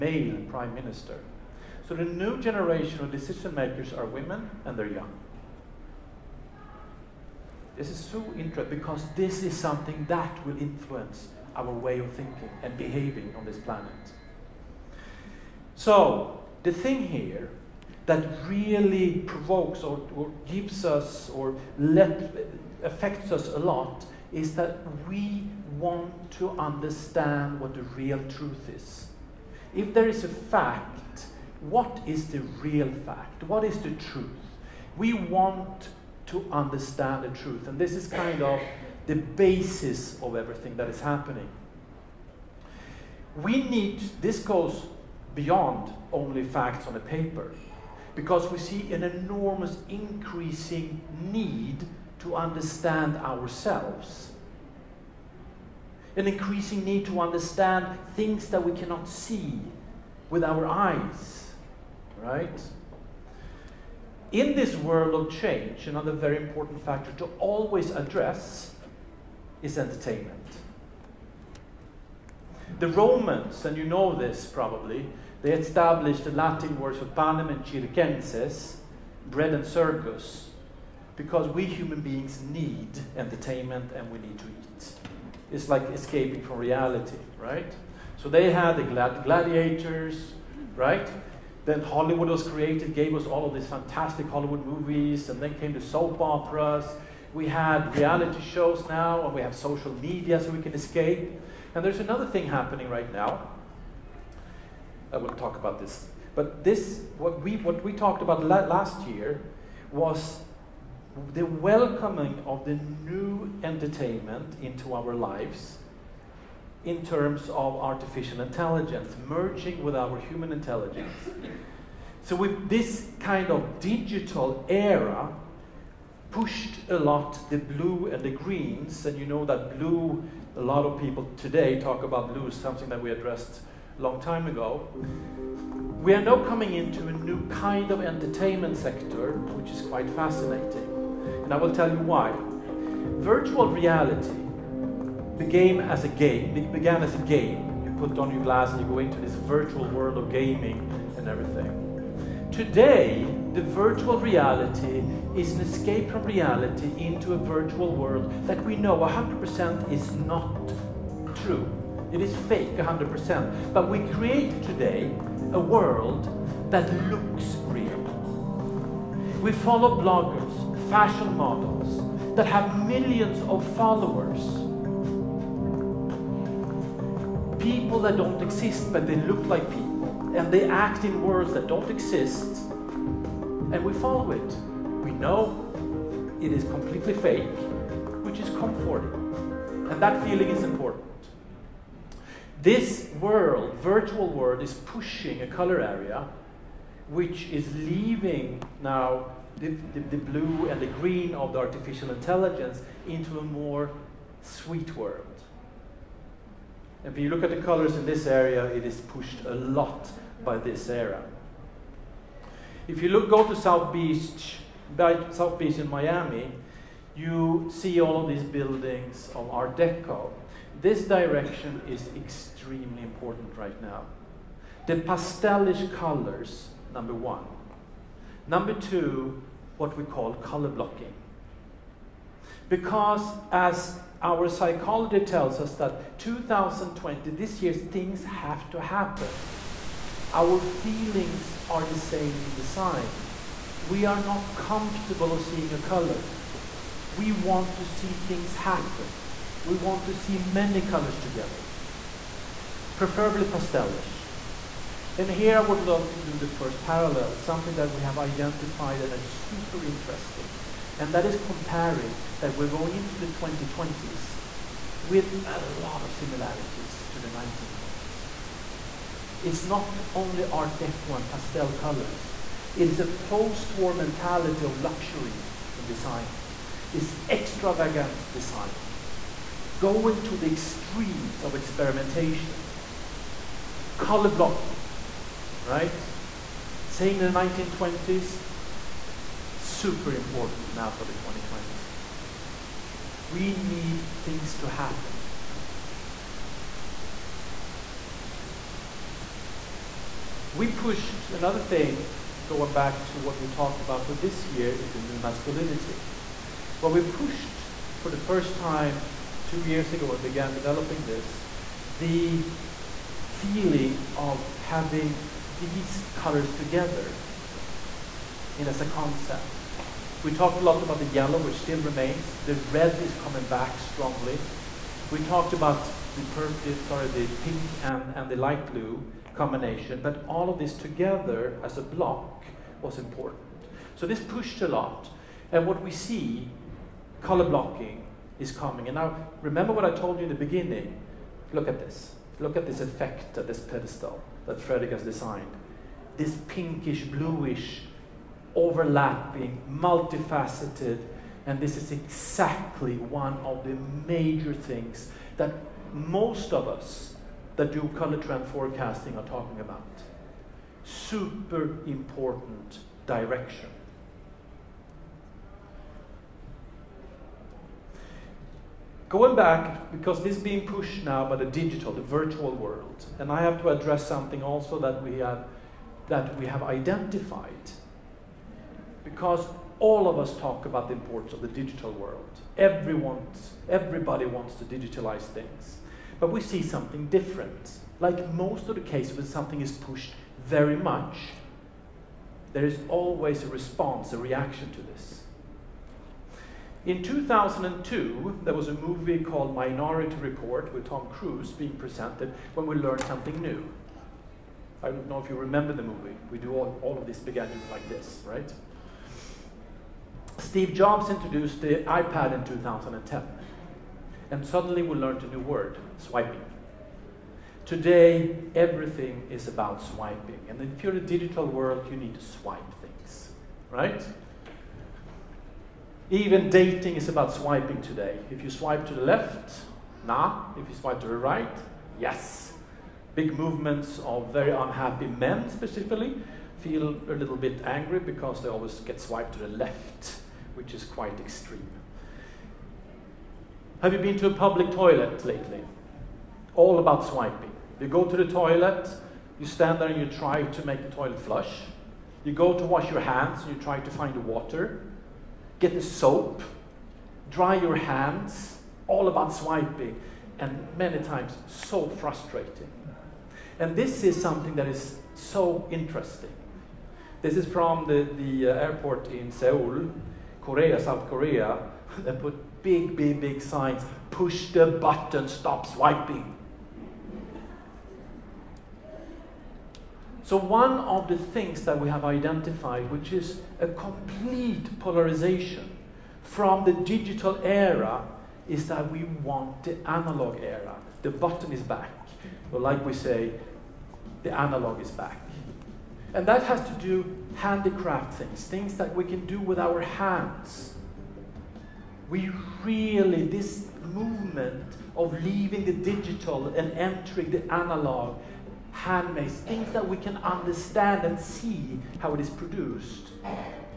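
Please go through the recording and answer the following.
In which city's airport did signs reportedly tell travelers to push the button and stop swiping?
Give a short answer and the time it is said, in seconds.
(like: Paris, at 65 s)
Seoul, at 469 s.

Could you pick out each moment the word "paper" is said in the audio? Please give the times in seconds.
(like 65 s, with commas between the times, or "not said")
46 s.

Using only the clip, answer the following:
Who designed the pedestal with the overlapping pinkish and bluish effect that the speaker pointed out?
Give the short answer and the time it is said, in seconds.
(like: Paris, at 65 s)
Frederick, at 344 s.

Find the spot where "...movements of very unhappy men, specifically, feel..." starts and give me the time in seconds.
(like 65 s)
433 s.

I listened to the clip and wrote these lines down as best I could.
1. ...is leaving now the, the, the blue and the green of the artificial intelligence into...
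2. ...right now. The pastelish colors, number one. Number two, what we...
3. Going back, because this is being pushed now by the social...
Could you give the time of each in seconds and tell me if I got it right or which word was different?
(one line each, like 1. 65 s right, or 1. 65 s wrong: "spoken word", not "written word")
1. 197 s right
2. 223 s right
3. 369 s wrong: "digital", not "social".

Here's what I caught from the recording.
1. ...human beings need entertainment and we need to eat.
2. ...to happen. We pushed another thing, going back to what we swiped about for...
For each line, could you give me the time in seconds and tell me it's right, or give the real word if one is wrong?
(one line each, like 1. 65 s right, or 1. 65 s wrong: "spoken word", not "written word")
1. 81 s right
2. 294 s wrong: "talked", not "swiped".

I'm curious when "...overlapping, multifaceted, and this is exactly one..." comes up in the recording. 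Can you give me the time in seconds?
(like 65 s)
348 s.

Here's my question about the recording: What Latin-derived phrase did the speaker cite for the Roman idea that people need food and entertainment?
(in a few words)
panem and circenses.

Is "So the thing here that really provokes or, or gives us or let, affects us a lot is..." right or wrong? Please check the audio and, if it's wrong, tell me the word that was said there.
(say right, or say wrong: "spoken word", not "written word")
right.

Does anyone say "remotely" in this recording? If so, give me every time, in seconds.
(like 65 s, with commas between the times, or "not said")
not said.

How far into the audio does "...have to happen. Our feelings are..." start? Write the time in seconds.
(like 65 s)
238 s.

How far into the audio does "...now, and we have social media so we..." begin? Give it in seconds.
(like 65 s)
98 s.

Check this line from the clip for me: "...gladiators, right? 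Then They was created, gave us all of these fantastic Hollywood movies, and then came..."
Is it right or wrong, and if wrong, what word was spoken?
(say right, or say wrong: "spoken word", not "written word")
wrong: "Hollywood", not "They".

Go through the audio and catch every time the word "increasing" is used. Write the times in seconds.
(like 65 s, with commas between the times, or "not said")
49 s, 56 s.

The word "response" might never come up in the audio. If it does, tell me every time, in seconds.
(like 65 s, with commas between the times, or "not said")
393 s.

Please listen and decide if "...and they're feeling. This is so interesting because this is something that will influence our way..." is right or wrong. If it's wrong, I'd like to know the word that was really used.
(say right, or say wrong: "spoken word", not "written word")
wrong: "young", not "feeling".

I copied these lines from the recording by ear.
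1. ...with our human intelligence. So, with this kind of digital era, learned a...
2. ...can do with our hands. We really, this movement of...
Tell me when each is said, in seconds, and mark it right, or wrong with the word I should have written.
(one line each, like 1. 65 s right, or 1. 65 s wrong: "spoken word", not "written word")
1. 119 s wrong: "pushed", not "learned"
2. 499 s right.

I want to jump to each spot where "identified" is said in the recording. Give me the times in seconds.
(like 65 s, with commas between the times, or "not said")
258 s, 376 s, 482 s.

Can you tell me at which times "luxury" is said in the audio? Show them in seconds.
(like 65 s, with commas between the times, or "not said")
274 s.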